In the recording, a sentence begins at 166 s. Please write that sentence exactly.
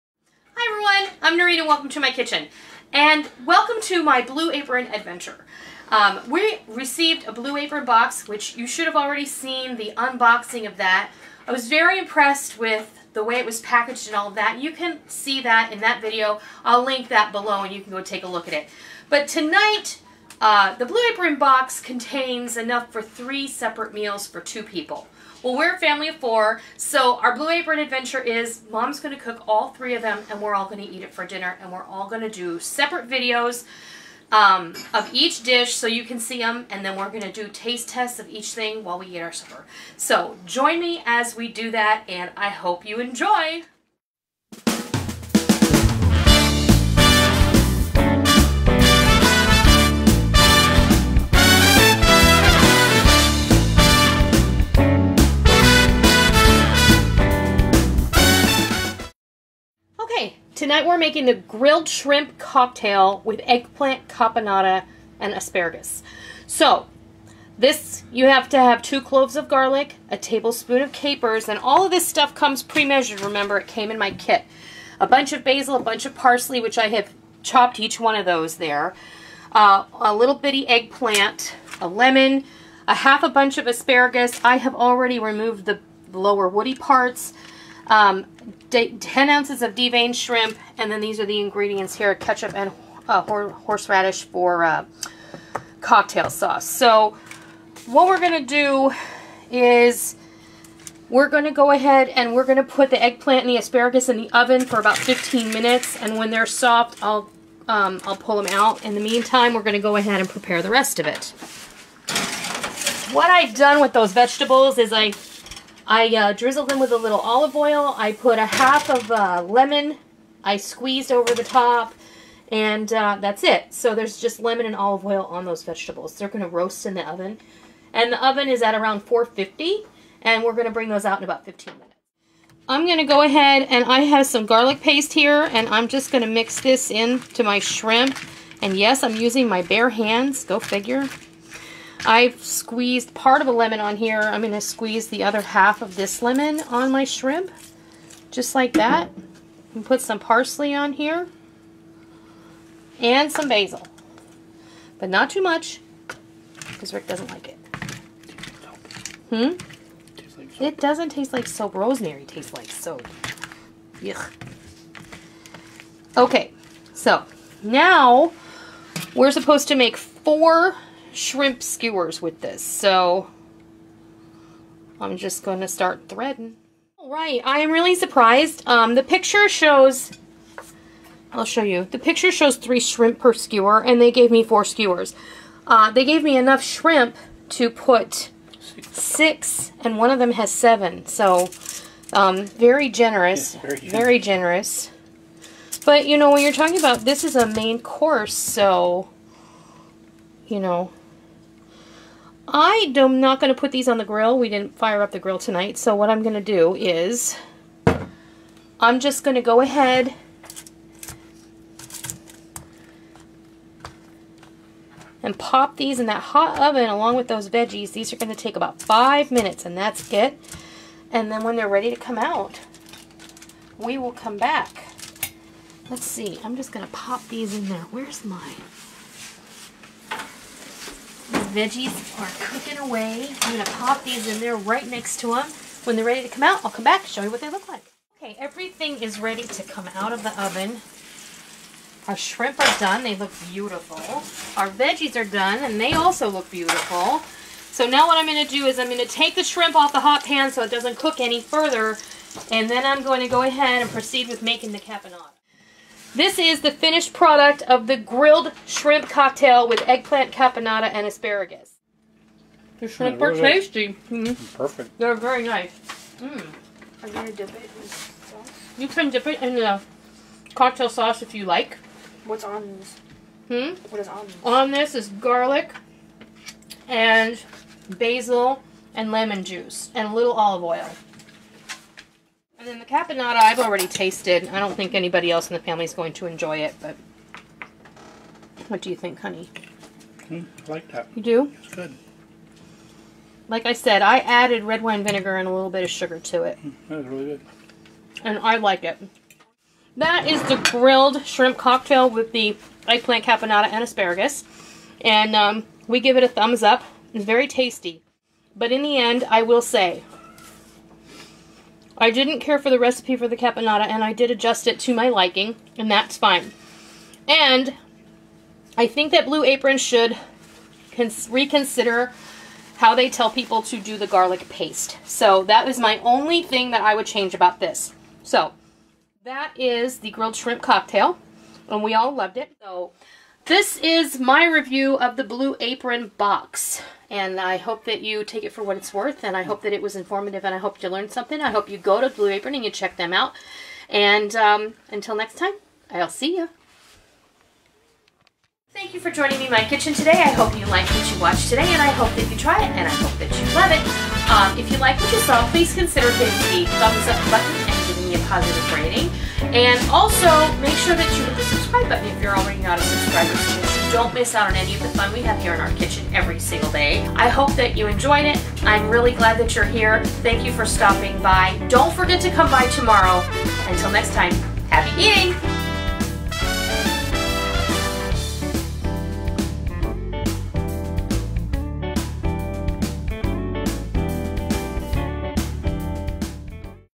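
Okay, so now we're supposed to make four shrimp skewers with this.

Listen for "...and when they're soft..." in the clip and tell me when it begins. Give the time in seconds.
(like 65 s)
106 s.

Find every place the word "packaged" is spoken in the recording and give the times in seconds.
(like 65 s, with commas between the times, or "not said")
13 s.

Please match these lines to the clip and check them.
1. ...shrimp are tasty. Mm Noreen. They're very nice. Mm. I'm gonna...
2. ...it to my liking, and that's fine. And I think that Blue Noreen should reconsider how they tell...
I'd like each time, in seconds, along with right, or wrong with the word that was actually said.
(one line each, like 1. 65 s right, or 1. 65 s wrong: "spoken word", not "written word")
1. 262 s wrong: "Perfect", not "Noreen"
2. 314 s wrong: "Apron", not "Noreen".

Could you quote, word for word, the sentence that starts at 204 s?
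We didn't fire up the grill tonight.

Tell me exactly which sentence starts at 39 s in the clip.
So join me as we do that, and I hope you enjoy!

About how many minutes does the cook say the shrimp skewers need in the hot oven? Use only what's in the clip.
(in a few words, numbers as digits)
5 minutes.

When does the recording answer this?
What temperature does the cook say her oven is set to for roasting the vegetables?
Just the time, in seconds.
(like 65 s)
129 s.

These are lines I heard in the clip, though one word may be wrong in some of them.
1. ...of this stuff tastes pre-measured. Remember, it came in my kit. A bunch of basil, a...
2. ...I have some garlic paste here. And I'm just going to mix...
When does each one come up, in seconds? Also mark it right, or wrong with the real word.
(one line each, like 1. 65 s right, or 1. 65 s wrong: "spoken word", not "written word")
1. 71 s wrong: "comes", not "tastes"
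2. 133 s right.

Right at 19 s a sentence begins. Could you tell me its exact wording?
But tonight, uh, the Blue Apron box contains enough for three separate meals for two people.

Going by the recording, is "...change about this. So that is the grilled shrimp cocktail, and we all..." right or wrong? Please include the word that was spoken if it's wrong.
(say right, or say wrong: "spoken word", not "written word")
right.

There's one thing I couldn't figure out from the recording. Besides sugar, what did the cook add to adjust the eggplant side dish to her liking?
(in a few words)
Red wine vinegar.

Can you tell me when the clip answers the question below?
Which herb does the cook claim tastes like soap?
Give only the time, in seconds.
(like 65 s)
161 s.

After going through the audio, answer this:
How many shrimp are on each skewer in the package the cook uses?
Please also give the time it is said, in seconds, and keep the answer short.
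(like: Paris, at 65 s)
3, at 182 s.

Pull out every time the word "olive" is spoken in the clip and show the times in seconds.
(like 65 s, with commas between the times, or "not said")
117 s, 124 s, 280 s.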